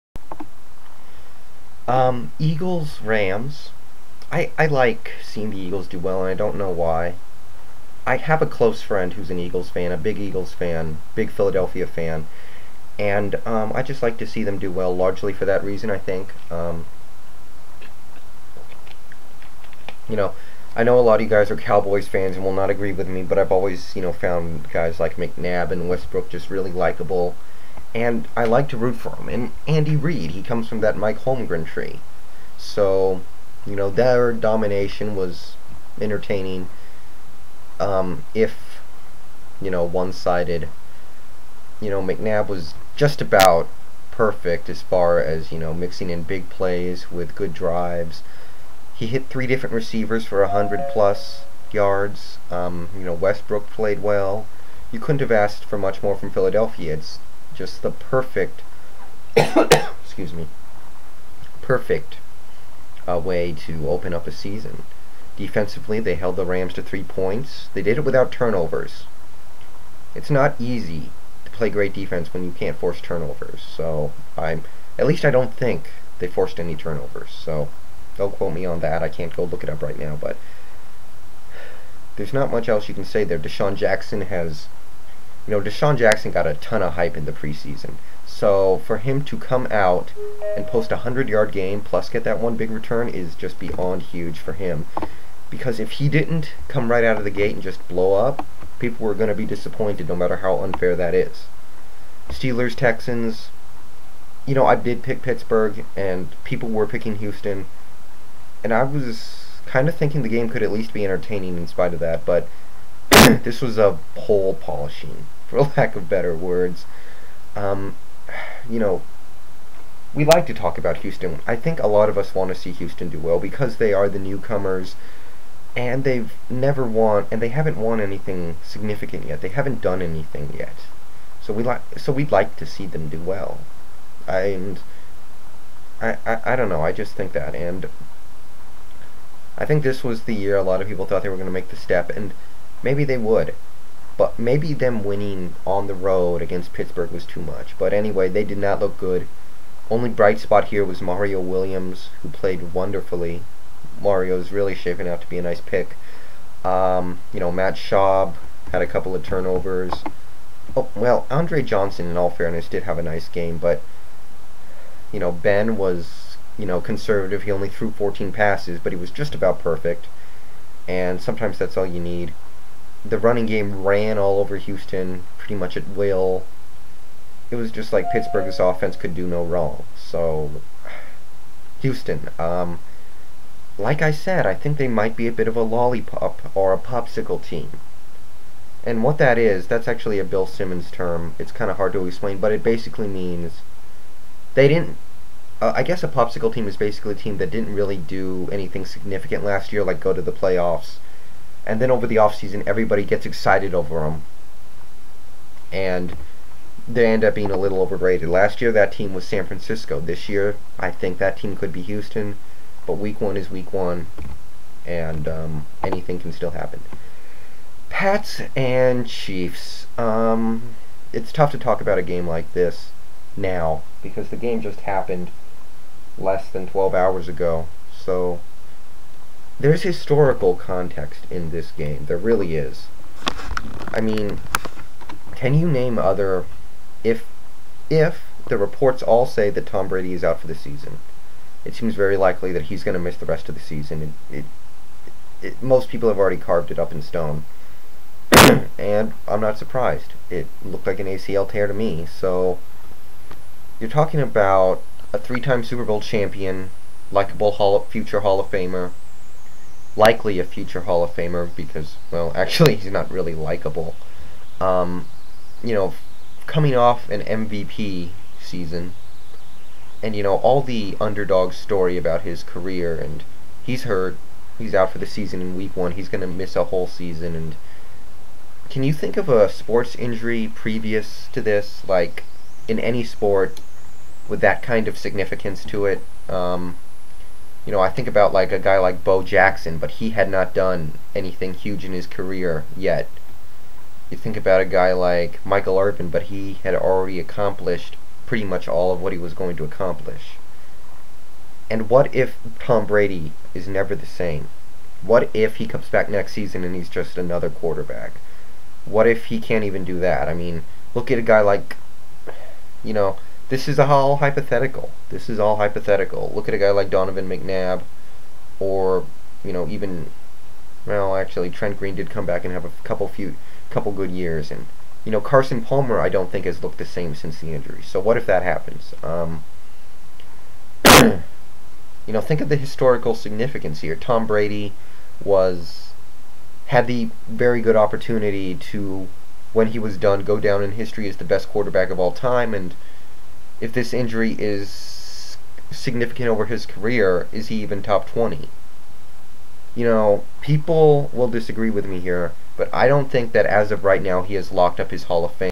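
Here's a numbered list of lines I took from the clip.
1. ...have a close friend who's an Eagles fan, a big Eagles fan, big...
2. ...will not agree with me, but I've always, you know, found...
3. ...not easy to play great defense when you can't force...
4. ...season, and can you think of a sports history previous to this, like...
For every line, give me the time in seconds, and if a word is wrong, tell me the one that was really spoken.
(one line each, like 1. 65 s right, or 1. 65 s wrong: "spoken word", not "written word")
1. 8 s right
2. 22 s right
3. 70 s right
4. 276 s wrong: "injury", not "history".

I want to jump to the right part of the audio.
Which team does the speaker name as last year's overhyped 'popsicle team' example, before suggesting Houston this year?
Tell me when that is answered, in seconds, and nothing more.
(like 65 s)
209 s.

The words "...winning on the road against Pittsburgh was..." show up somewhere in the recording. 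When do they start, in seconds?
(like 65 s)
145 s.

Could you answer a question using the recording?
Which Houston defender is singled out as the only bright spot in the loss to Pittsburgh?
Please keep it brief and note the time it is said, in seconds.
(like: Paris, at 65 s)
Mario Williams, at 151 s.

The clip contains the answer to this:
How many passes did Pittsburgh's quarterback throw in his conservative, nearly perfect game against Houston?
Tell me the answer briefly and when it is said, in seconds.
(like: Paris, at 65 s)
14, at 167 s.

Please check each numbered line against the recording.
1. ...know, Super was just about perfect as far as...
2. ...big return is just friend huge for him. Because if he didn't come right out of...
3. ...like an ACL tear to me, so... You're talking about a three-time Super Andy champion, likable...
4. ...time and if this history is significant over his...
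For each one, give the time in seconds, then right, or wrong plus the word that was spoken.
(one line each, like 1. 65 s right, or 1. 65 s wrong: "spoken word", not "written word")
1. 41 s wrong: "McNabb", not "Super"
2. 92 s wrong: "beyond", not "friend"
3. 250 s wrong: "Bowl", not "Andy"
4. 342 s wrong: "injury", not "history".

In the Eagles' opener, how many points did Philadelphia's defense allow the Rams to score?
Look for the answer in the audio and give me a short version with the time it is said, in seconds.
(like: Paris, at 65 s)
3, at 66 s.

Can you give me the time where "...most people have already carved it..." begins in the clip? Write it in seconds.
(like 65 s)
245 s.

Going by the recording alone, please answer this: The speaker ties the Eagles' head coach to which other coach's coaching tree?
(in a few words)
Mike Holmgren.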